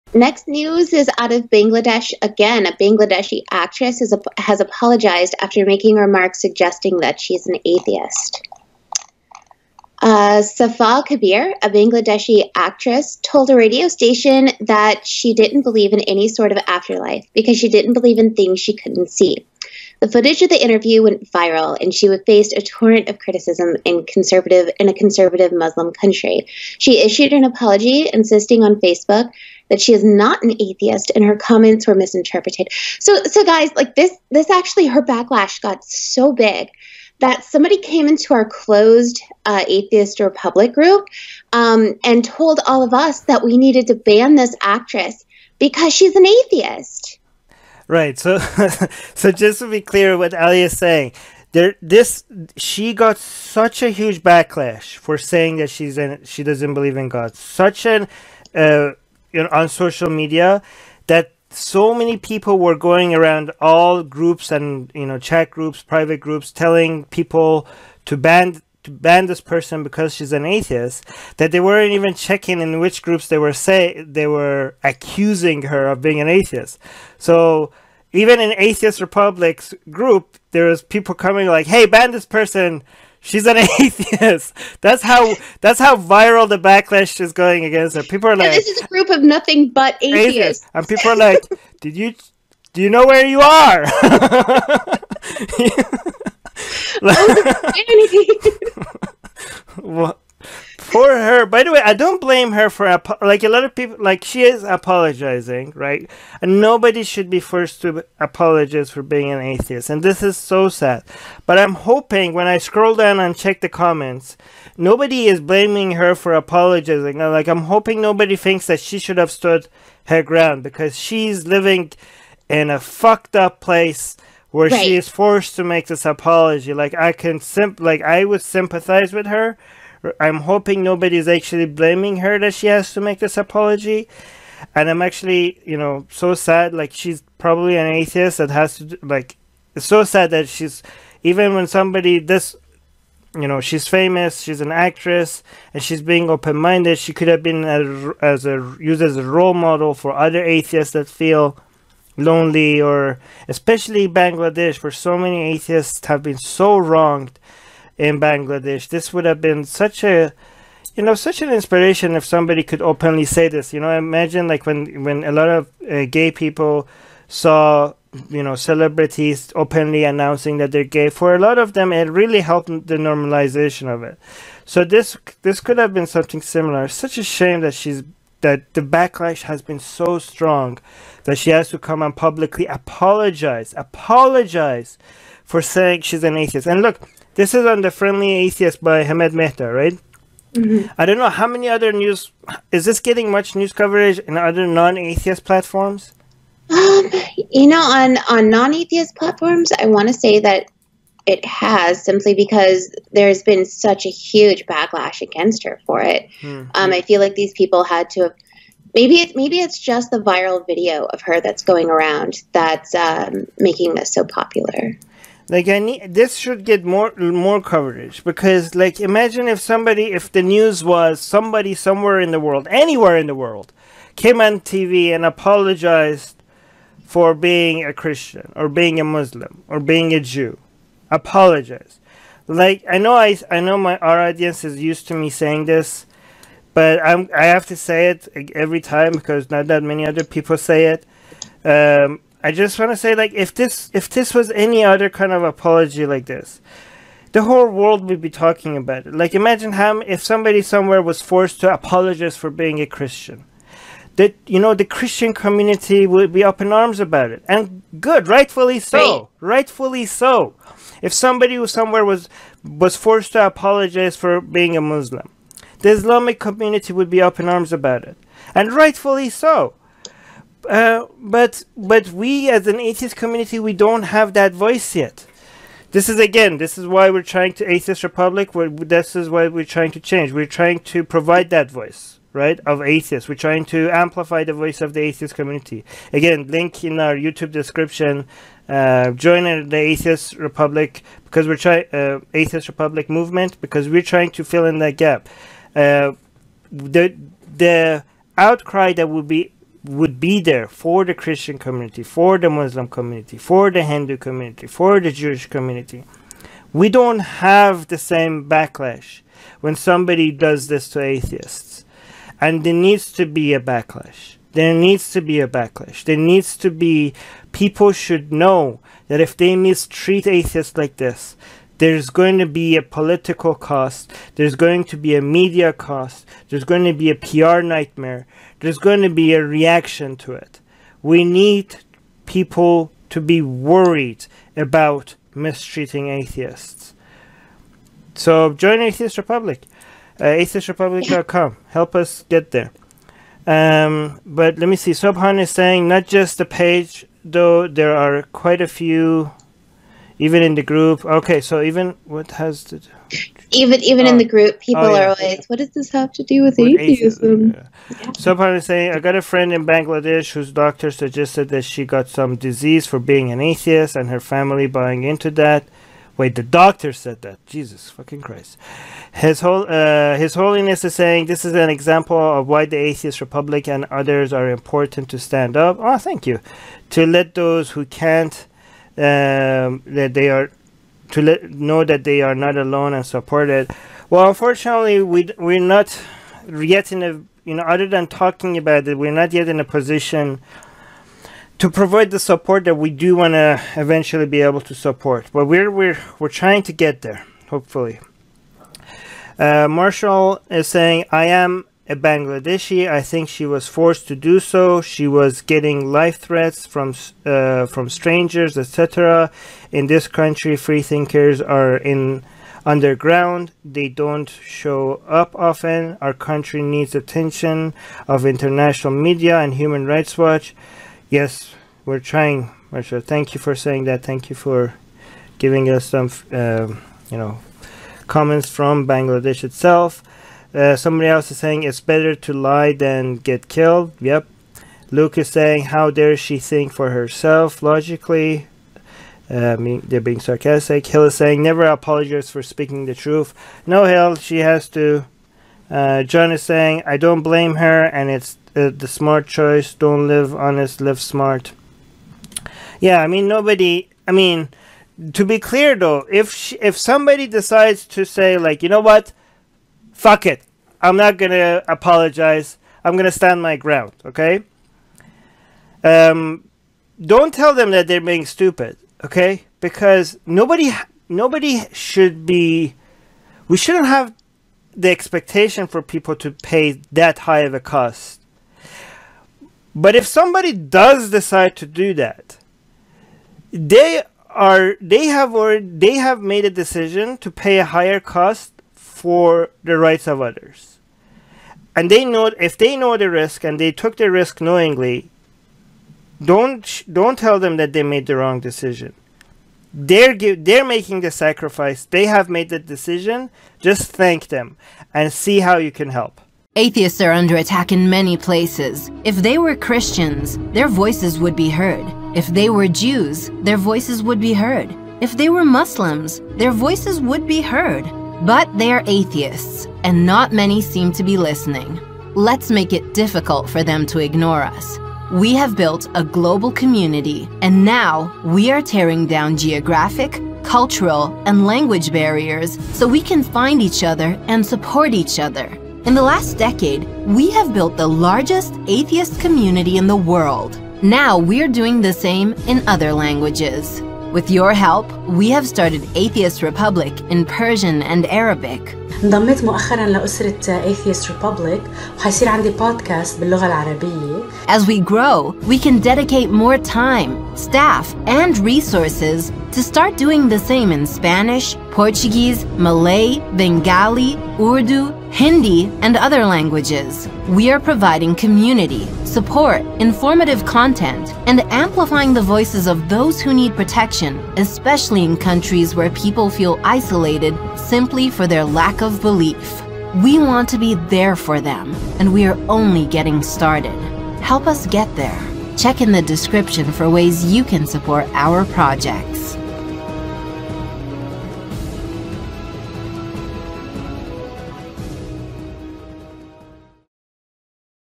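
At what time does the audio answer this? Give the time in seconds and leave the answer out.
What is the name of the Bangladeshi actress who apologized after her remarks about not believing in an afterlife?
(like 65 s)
10 s.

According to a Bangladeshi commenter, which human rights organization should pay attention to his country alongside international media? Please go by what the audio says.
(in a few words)
Human Rights Watch.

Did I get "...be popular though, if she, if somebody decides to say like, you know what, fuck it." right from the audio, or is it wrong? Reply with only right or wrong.
wrong.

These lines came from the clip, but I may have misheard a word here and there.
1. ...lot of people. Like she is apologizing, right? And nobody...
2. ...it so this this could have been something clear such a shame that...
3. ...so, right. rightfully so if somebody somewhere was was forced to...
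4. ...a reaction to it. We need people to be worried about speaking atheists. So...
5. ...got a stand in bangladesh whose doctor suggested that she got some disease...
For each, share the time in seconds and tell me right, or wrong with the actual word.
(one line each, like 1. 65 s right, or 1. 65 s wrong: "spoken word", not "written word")
1. 103 s right
2. 174 s wrong: "similar", not "clear"
3. 258 s right
4. 329 s wrong: "mistreating", not "speaking"
5. 358 s wrong: "friend", not "stand".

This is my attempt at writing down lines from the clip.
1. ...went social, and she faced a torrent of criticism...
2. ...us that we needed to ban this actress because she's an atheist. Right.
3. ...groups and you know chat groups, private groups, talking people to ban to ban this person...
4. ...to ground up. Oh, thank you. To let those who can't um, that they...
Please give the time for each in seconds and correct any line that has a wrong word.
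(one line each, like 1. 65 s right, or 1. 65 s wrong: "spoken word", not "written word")
1. 21 s wrong: "viral", not "social"
2. 42 s right
3. 64 s wrong: "telling", not "talking"
4. 375 s wrong: "stand", not "ground".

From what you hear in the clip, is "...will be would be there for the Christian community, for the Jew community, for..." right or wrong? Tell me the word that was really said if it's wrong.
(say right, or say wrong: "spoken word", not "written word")
wrong: "Muslim", not "Jew".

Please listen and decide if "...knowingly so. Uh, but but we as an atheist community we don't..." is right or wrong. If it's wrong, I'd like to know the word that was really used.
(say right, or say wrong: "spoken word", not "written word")
wrong: "rightfully", not "knowingly".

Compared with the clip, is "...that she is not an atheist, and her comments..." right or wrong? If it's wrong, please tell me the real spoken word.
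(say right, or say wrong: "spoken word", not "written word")
right.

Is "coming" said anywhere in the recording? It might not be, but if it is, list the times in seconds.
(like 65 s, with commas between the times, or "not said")
81 s.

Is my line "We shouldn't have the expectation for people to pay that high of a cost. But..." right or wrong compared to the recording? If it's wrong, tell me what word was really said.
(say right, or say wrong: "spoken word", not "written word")
right.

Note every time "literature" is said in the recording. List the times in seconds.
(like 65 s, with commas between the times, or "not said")
not said.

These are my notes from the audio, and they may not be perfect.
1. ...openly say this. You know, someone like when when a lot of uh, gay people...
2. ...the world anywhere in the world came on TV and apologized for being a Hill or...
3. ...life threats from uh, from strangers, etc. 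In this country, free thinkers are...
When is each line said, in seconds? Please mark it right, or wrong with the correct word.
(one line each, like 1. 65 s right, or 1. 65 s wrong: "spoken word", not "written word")
1. 162 s wrong: "imagine", not "someone"
2. 222 s wrong: "Christian", not "Hill"
3. 405 s right.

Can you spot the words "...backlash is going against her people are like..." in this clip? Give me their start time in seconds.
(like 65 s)
86 s.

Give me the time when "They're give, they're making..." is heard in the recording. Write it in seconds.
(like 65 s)
499 s.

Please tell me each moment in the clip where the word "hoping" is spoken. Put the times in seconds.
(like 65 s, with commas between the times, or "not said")
111 s, 117 s, 130 s.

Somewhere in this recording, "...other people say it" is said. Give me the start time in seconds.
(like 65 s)
240 s.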